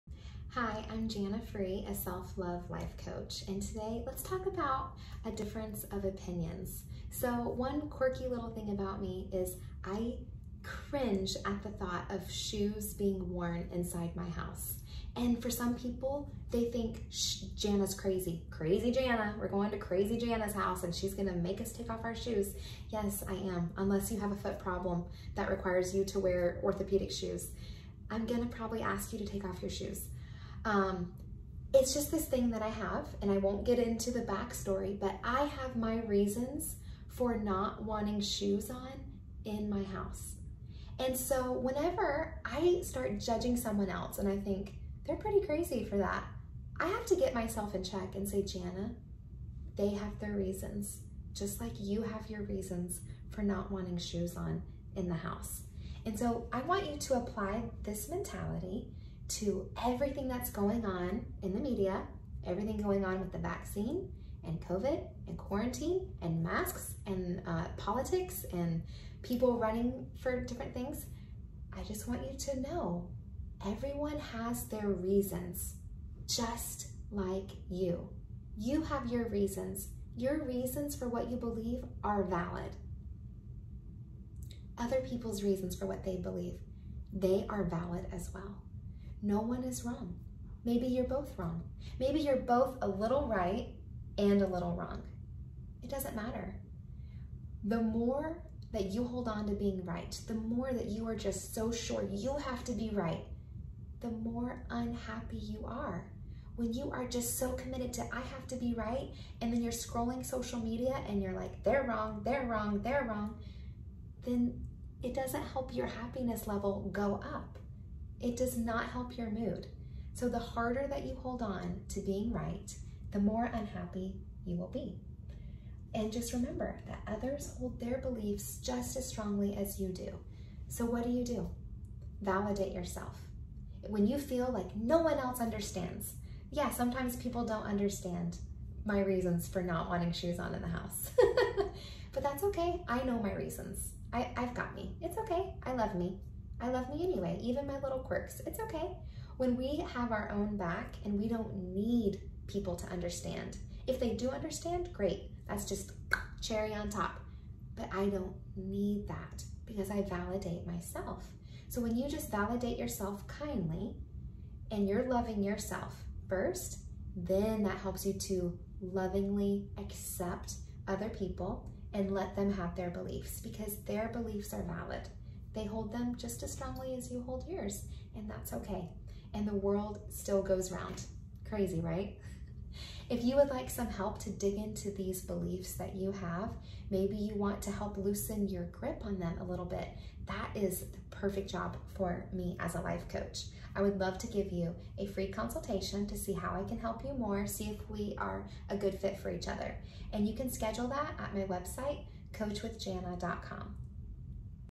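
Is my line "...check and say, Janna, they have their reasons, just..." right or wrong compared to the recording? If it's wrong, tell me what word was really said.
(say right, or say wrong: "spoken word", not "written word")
right.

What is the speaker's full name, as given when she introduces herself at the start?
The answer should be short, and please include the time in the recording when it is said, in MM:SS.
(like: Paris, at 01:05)
Janna Frei, at 00:01.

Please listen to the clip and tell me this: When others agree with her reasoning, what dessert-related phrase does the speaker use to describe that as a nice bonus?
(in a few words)
cherry on top.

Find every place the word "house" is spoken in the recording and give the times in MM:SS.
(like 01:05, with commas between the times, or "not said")
00:14, 00:20, 00:39, 00:55, 02:20.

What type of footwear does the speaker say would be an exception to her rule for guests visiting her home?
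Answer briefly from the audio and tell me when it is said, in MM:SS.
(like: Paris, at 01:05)
orthopedic shoes, at 00:26.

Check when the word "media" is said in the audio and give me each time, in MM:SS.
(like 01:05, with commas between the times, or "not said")
01:01, 01:50.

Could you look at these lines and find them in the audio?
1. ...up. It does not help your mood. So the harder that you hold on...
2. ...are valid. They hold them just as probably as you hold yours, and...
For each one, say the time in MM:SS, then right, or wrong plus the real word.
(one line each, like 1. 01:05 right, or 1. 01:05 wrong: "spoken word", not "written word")
1. 01:57 right
2. 02:54 wrong: "strongly", not "probably".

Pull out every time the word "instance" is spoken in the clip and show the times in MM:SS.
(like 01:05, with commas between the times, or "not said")
not said.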